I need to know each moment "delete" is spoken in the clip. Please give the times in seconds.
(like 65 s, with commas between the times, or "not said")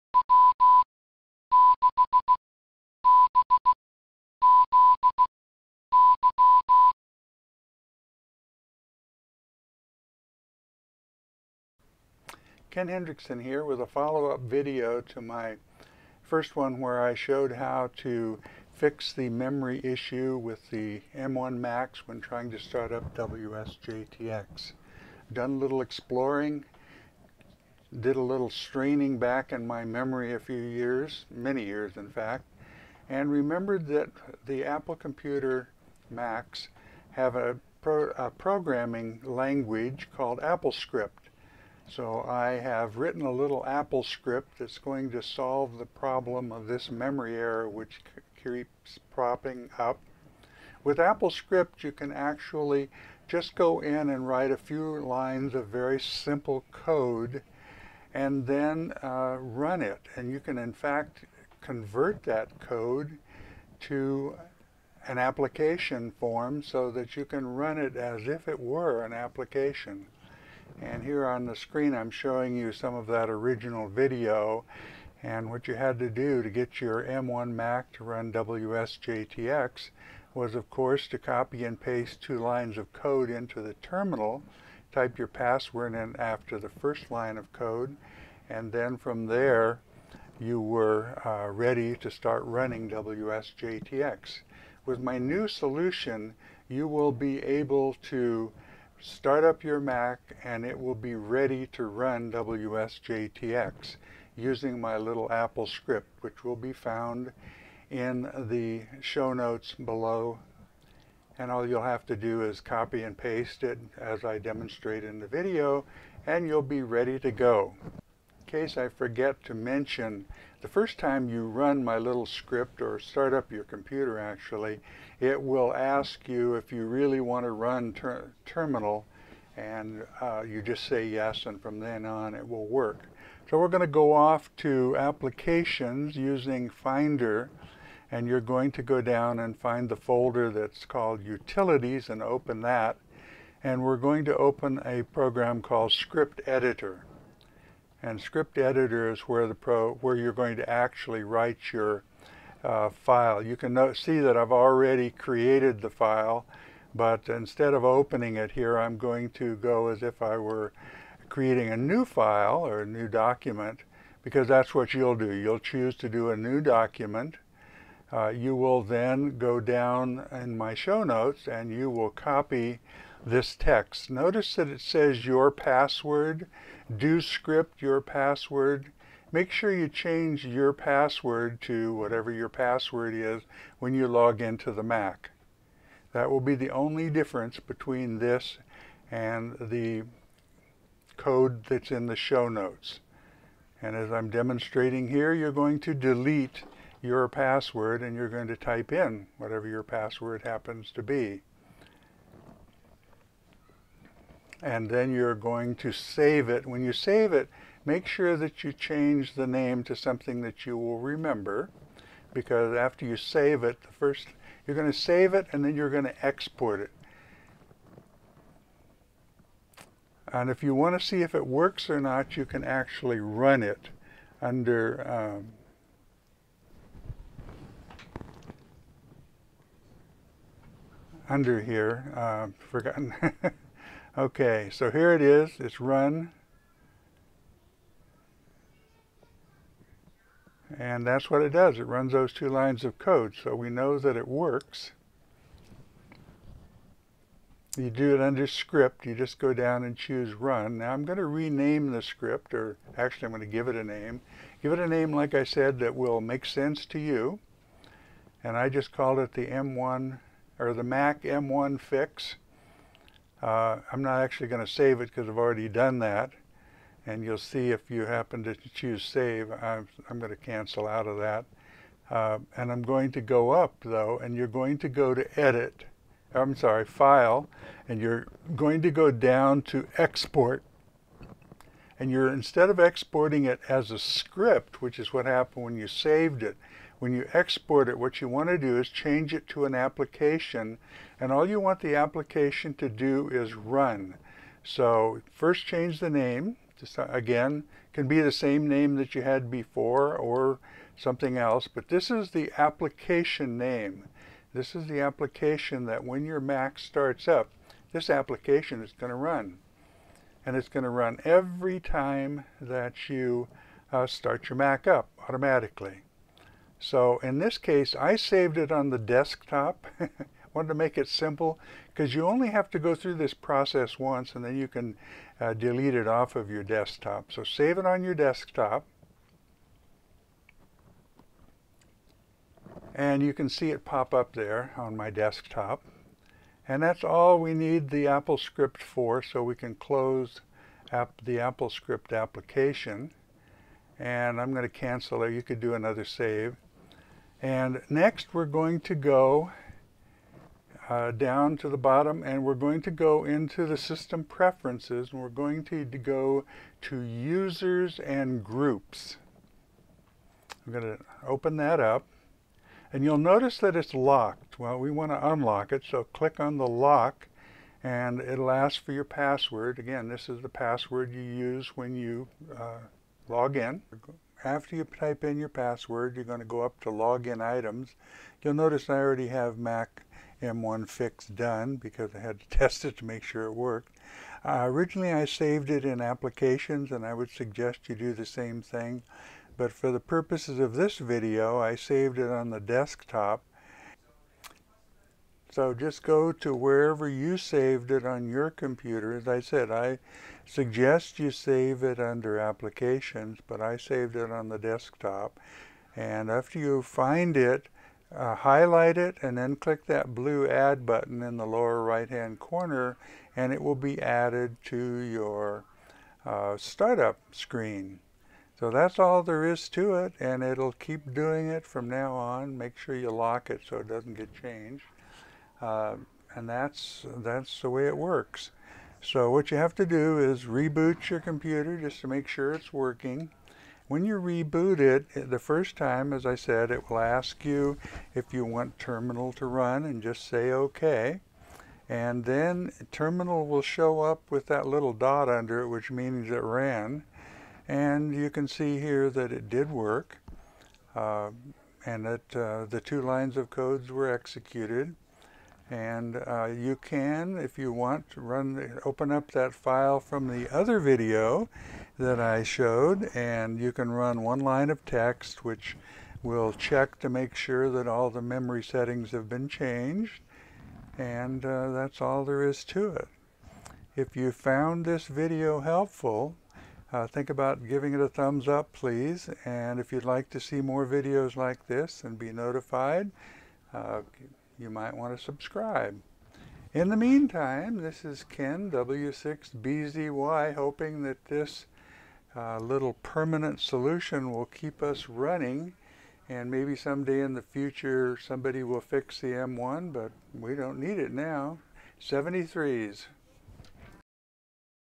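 195 s, 325 s.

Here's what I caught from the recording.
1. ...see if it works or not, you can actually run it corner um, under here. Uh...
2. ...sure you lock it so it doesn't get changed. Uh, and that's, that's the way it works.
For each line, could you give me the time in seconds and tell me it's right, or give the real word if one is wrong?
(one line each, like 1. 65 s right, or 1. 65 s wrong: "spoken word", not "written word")
1. 221 s wrong: "under", not "corner"
2. 422 s right.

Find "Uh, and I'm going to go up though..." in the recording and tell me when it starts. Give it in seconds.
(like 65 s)
272 s.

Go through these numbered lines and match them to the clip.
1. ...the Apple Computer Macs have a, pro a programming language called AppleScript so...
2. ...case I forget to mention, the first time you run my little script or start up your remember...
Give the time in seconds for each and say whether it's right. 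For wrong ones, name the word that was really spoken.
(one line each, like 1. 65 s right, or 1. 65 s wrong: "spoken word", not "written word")
1. 34 s right
2. 118 s wrong: "computer", not "remember".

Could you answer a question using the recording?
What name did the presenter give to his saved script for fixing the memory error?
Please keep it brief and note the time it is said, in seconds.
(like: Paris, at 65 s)
Mac M1 Fix, at 260 s.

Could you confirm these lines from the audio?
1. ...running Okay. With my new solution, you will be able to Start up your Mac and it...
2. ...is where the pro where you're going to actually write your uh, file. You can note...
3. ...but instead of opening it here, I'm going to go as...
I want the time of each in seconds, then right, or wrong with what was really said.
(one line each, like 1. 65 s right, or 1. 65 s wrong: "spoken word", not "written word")
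1. 92 s wrong: "WSJTX", not "Okay"
2. 149 s right
3. 156 s right.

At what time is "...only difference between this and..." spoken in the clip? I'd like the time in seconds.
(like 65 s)
186 s.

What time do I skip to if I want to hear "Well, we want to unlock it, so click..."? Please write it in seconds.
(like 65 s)
364 s.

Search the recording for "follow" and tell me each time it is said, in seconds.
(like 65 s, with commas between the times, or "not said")
13 s.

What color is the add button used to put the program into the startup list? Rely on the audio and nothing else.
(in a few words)
Blue.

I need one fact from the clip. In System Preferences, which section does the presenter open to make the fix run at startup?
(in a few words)
Users and Groups.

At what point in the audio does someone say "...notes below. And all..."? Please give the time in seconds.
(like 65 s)
109 s.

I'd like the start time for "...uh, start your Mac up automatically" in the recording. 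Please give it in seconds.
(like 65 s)
313 s.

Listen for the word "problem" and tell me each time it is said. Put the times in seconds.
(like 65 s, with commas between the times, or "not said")
45 s.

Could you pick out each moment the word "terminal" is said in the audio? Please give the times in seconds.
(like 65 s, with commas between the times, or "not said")
83 s, 128 s, 438 s, 442 s.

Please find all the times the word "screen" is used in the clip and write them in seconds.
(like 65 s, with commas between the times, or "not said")
71 s, 417 s.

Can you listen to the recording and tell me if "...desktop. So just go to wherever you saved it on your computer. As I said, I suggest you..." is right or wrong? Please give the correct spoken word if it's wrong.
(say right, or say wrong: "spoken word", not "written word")
right.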